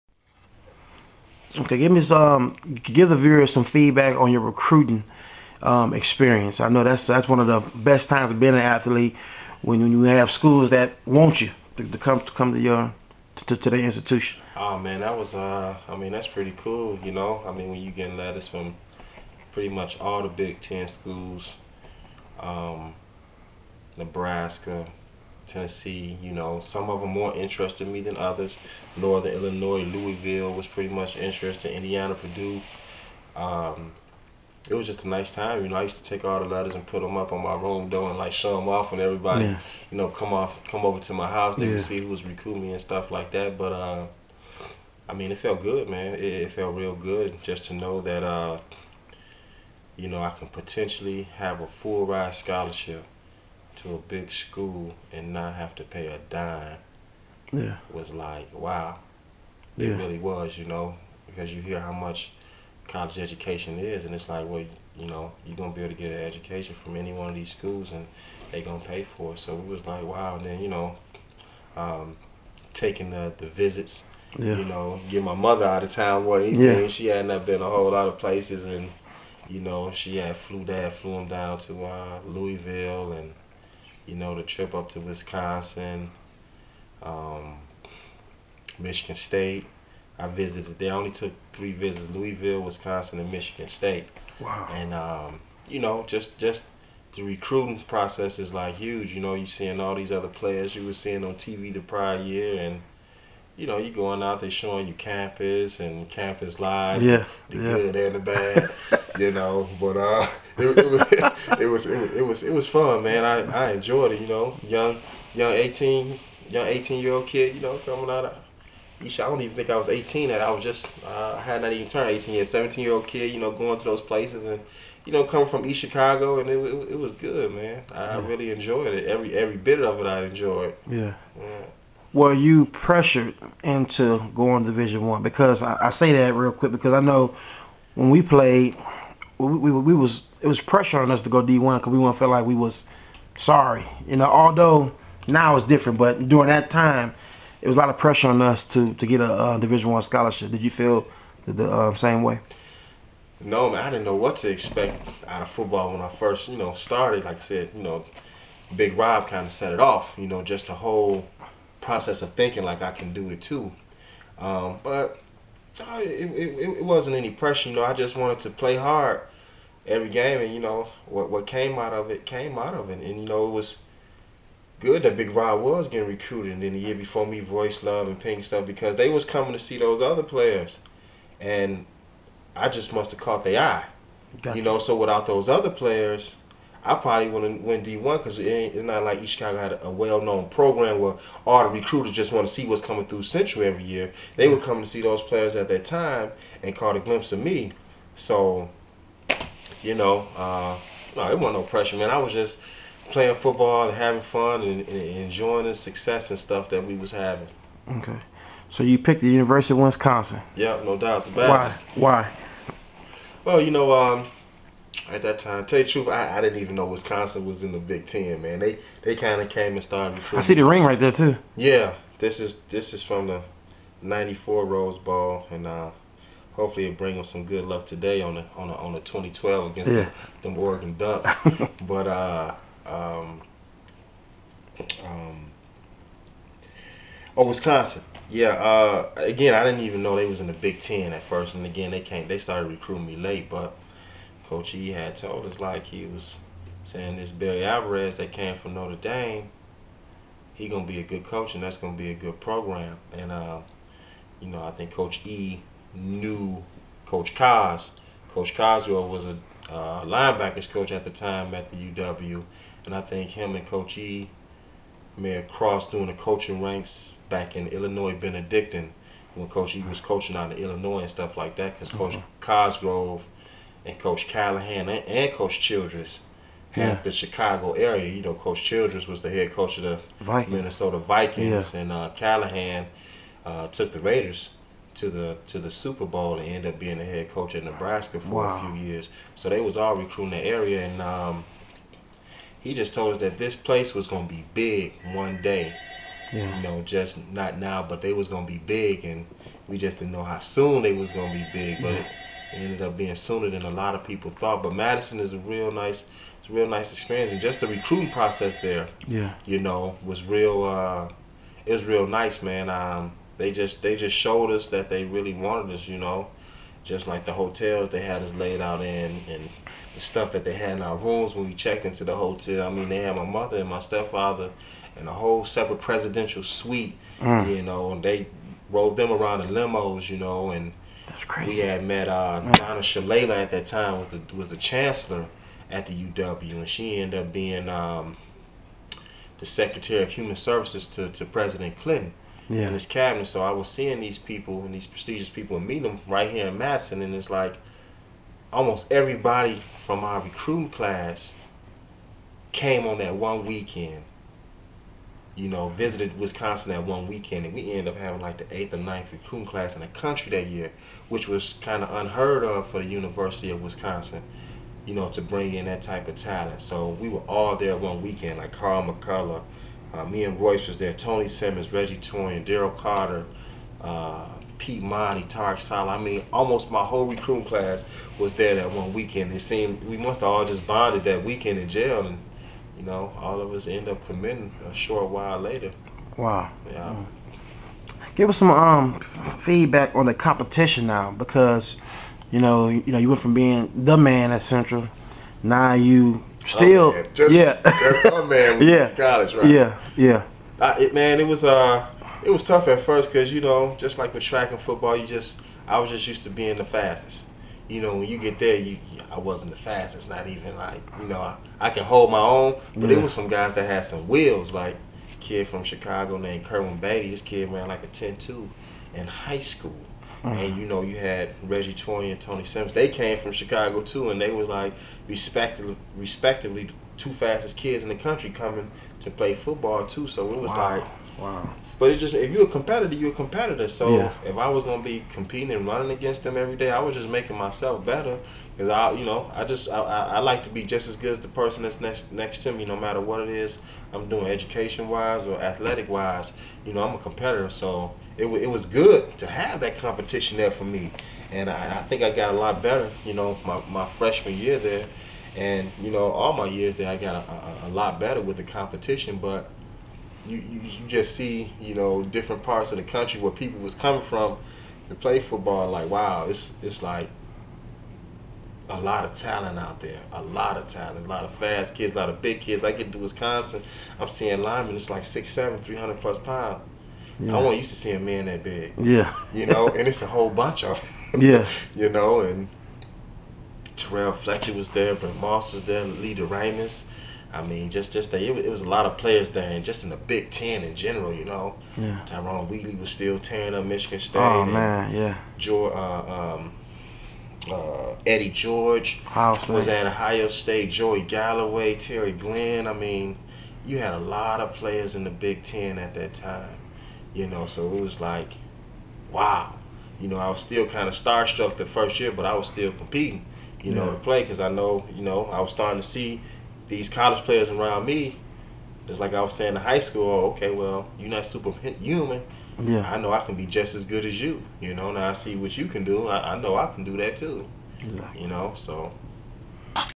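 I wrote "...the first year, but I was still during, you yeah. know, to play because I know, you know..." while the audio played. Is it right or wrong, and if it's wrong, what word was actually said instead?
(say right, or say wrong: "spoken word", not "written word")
wrong: "competing", not "during".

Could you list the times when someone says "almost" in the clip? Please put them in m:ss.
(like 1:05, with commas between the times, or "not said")
5:48, 6:16.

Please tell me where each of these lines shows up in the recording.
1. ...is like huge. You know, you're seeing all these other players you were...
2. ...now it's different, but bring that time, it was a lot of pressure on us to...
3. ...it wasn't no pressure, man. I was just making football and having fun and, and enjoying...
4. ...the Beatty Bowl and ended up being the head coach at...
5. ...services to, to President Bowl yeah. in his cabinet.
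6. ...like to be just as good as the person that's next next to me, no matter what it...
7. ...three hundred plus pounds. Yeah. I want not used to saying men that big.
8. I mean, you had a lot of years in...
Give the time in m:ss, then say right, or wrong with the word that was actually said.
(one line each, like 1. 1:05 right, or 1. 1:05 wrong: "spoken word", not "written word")
1. 1:38 right
2. 2:25 wrong: "during", not "bring"
3. 3:21 wrong: "playing", not "making"
4. 4:45 wrong: "Super", not "Beatty"
5. 5:40 wrong: "Clinton", not "Bowl"
6. 7:20 right
7. 7:55 wrong: "seeing", not "saying"
8. 8:22 wrong: "players", not "years".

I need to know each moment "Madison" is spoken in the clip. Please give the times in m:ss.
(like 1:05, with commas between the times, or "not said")
5:04, 5:46.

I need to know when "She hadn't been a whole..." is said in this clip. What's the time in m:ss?
1:16.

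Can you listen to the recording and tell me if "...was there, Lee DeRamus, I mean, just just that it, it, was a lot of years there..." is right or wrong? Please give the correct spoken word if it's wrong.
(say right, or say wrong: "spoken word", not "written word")
wrong: "players", not "years".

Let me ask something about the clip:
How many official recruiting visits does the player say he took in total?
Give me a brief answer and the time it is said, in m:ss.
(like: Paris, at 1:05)
3, at 1:31.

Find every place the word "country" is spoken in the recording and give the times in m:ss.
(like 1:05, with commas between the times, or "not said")
5:59, 7:07, 7:42.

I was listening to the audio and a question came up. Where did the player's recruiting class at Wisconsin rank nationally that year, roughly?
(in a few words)
8th or 9th.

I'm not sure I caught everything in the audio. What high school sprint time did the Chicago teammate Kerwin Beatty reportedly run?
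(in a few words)
10.2.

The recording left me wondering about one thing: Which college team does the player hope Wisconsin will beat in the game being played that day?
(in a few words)
Oregon Ducks.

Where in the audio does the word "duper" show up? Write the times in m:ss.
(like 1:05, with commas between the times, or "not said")
not said.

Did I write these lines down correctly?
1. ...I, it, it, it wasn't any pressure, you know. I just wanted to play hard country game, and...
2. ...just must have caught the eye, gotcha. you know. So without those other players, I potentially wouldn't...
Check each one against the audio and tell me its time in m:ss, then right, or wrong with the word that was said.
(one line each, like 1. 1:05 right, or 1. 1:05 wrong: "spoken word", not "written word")
1. 2:45 wrong: "every", not "country"
2. 3:02 wrong: "probably", not "potentially".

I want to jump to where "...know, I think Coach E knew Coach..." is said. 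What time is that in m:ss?
4:14.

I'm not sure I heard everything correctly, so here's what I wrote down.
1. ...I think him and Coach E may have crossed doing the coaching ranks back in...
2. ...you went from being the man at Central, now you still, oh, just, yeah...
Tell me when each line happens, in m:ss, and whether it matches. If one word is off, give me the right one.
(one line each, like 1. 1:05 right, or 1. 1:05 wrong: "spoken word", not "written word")
1. 4:22 right
2. 6:32 right.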